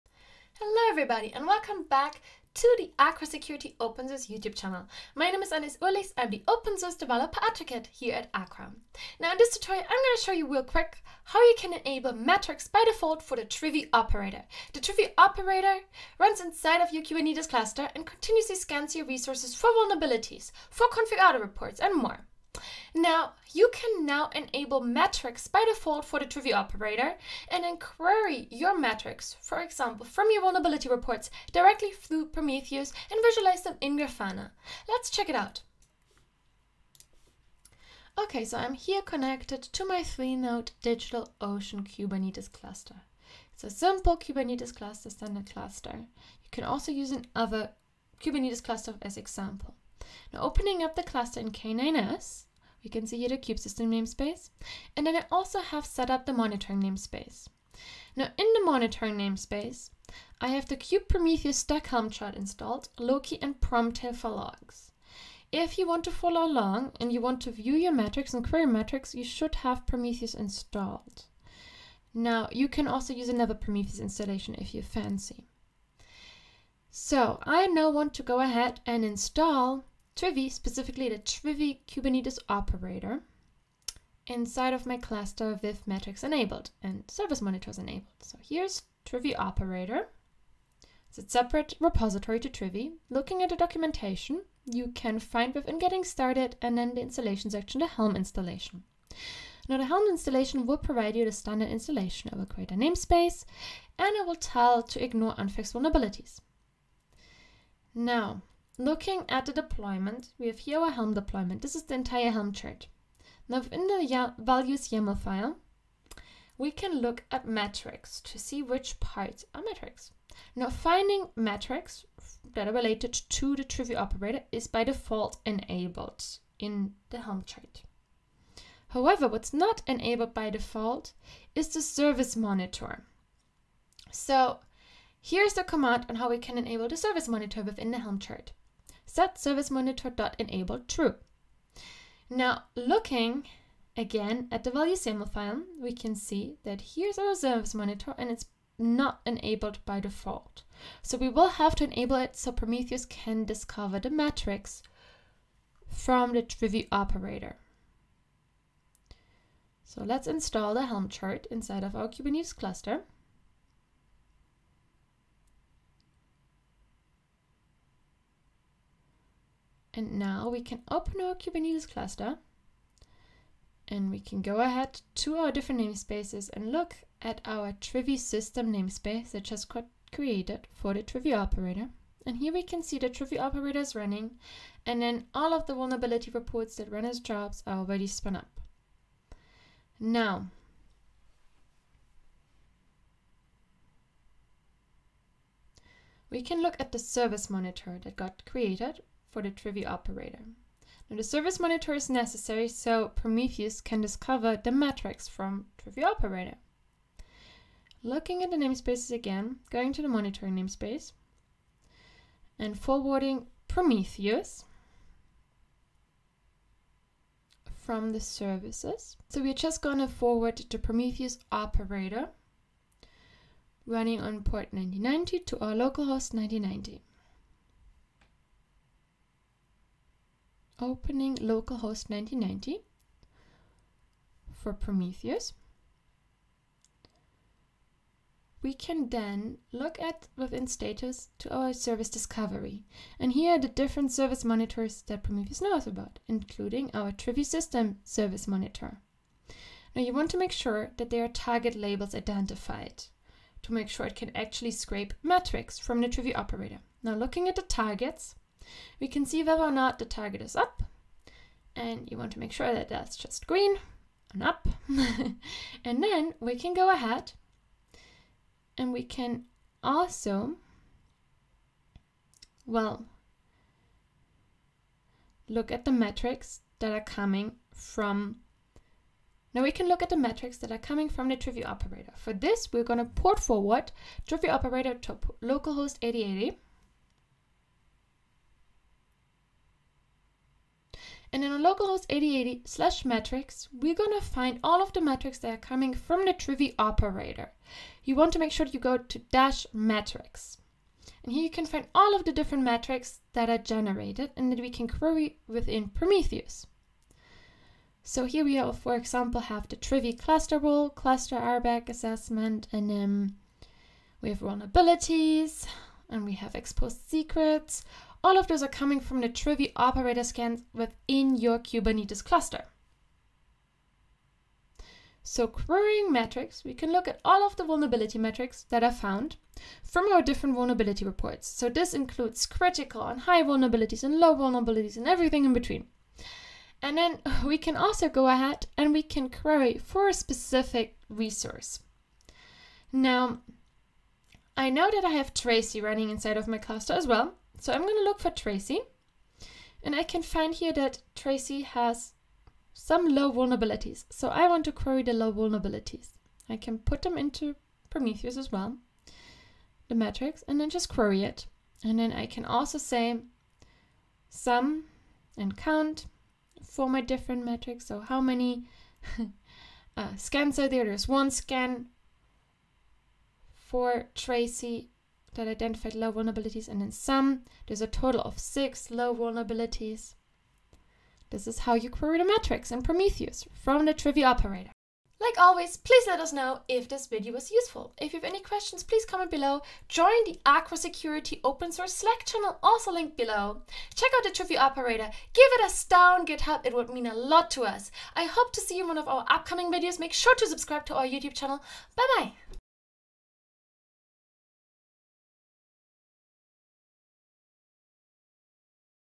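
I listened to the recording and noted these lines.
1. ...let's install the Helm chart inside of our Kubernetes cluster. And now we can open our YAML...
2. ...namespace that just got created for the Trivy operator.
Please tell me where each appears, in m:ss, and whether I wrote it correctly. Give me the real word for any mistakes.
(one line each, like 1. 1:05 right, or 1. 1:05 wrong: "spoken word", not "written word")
1. 2:40 wrong: "Kubernetes", not "YAML"
2. 2:58 right.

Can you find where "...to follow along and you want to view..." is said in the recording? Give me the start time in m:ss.
1:06.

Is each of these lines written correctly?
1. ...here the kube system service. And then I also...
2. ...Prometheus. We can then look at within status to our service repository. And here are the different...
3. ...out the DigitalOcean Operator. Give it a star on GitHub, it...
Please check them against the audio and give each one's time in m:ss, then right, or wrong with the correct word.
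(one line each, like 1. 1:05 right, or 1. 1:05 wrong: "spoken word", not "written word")
1. 0:53 wrong: "namespace", not "service"
2. 3:54 wrong: "discovery", not "repository"
3. 6:34 wrong: "Trivy", not "DigitalOcean".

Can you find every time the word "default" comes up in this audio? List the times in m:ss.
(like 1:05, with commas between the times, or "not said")
0:12, 0:25, 2:04, 2:10, 2:29.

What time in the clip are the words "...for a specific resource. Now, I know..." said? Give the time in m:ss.
5:39.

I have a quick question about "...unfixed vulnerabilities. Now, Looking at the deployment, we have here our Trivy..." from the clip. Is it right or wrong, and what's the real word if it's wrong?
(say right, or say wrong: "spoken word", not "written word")
wrong: "Helm", not "Trivy".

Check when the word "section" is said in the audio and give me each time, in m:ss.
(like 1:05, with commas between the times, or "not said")
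1:37.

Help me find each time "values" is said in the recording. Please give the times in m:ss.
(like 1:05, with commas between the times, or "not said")
1:54, 2:24.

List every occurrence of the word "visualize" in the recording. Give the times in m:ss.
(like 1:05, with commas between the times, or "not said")
0:33.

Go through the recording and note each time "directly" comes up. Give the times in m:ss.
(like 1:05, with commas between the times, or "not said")
0:31.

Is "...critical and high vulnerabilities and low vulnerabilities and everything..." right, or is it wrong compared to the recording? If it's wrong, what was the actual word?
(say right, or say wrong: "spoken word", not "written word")
right.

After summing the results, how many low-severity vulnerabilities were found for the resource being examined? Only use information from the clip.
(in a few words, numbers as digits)
6.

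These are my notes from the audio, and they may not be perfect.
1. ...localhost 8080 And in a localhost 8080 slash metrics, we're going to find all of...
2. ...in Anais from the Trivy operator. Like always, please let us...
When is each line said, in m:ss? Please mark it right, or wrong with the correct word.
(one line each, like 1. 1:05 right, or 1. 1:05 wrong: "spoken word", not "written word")
1. 4:45 right
2. 6:22 wrong: "Prometheus", not "Anais".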